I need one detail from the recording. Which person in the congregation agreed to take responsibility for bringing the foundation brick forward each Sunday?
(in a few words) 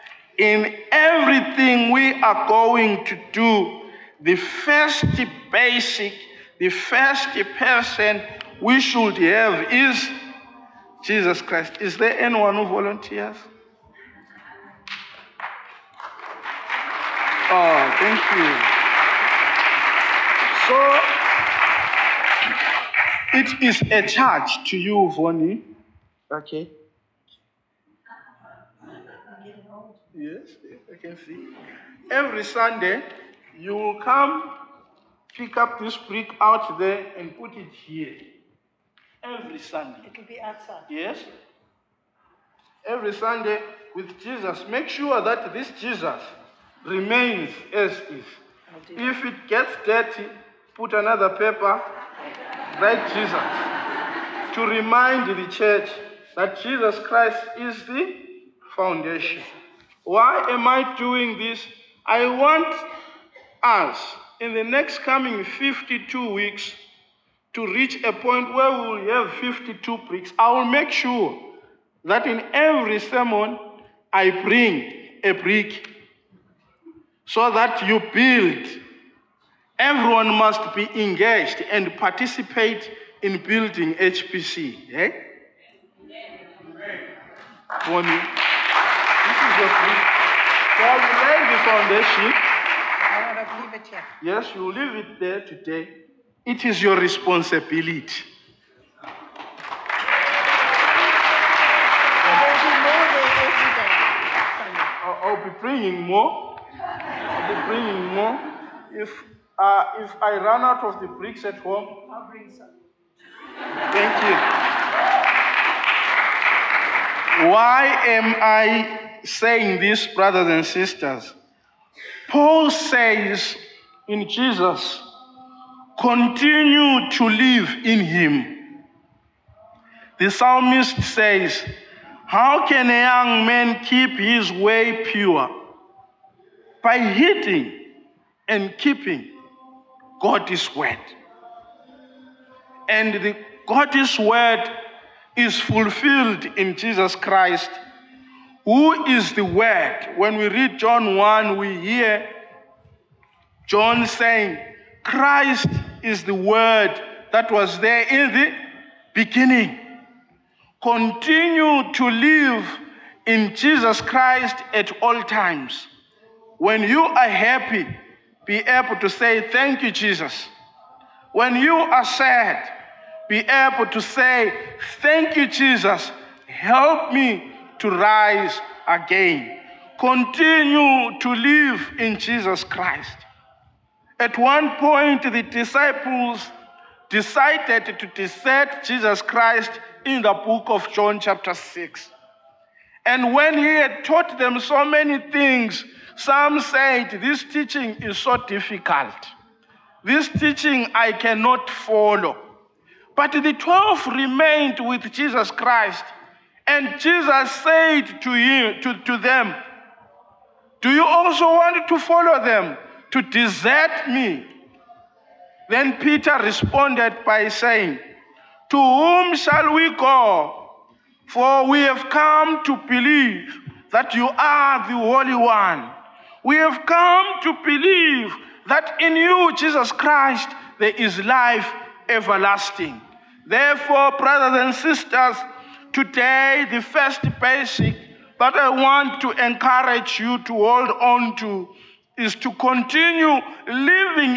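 Vonnie.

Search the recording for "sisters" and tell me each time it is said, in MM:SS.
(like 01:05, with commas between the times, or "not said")
02:00, 03:54.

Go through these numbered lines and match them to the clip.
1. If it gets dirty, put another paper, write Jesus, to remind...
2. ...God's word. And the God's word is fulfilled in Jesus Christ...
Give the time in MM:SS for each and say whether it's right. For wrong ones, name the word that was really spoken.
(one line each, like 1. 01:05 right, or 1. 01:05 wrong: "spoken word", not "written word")
1. 00:48 right
2. 02:20 right.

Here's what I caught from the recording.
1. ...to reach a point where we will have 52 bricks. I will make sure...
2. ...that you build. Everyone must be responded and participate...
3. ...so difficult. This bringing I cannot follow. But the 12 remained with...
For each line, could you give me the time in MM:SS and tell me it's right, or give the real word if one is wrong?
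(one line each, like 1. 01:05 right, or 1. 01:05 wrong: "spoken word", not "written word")
1. 01:07 right
2. 01:17 wrong: "engaged", not "responded"
3. 03:18 wrong: "teaching", not "bringing".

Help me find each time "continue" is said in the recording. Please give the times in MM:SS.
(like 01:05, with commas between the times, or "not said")
02:05, 02:40, 02:59, 04:02.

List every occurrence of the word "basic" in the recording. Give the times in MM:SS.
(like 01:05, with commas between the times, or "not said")
00:05, 03:57.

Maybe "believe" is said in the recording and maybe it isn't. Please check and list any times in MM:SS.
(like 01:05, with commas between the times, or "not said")
03:42, 03:47.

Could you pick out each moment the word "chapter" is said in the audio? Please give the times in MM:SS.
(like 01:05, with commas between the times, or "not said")
03:11.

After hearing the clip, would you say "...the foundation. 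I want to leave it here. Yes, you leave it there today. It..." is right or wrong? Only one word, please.
right.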